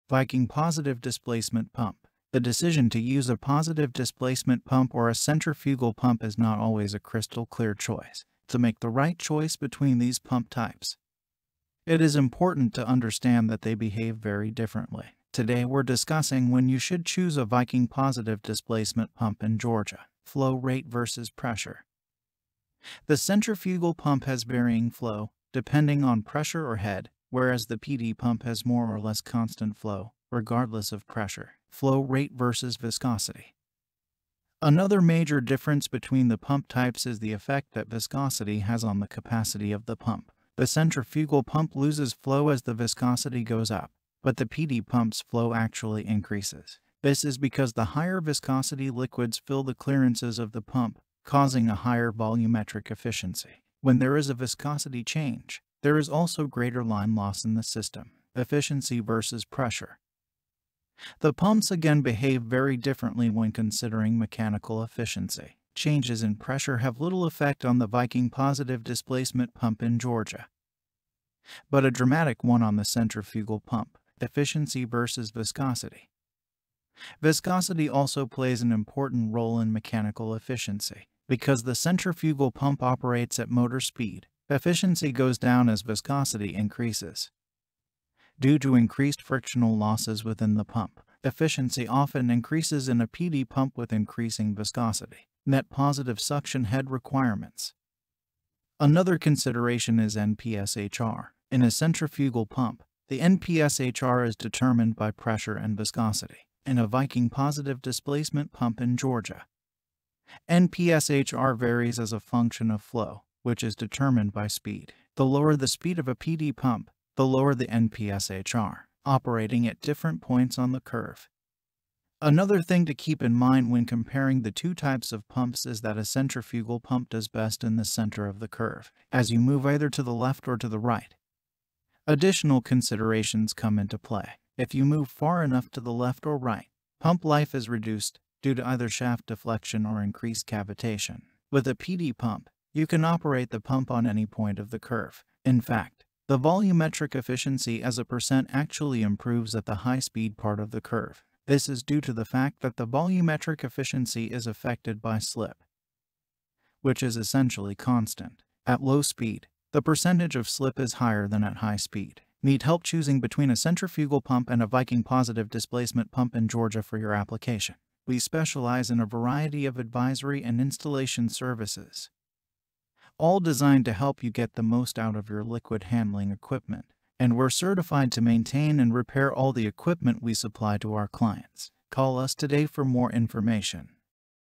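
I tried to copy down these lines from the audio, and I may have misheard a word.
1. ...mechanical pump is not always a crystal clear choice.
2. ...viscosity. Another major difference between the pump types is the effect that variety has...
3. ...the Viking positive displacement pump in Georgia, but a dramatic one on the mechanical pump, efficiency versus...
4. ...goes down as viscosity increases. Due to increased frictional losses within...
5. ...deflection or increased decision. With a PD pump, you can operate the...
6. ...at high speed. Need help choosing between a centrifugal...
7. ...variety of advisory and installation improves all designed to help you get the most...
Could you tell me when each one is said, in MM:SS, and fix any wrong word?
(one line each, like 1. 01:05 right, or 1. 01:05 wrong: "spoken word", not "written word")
1. 00:05 wrong: "centrifugal", not "mechanical"
2. 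00:32 wrong: "viscosity", not "variety"
3. 01:07 wrong: "centrifugal", not "mechanical"
4. 01:25 right
5. 02:19 wrong: "cavitation", not "decision"
6. 02:41 right
7. 02:49 wrong: "services", not "improves".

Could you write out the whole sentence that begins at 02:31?
This is due to the fact that the volumetric efficiency is affected by slip, which is essentially constant.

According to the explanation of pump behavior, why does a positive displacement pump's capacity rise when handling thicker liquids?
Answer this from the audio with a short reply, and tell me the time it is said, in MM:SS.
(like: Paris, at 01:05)
Higher volumetric efficiency, at 00:51.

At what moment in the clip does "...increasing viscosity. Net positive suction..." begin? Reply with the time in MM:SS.
01:33.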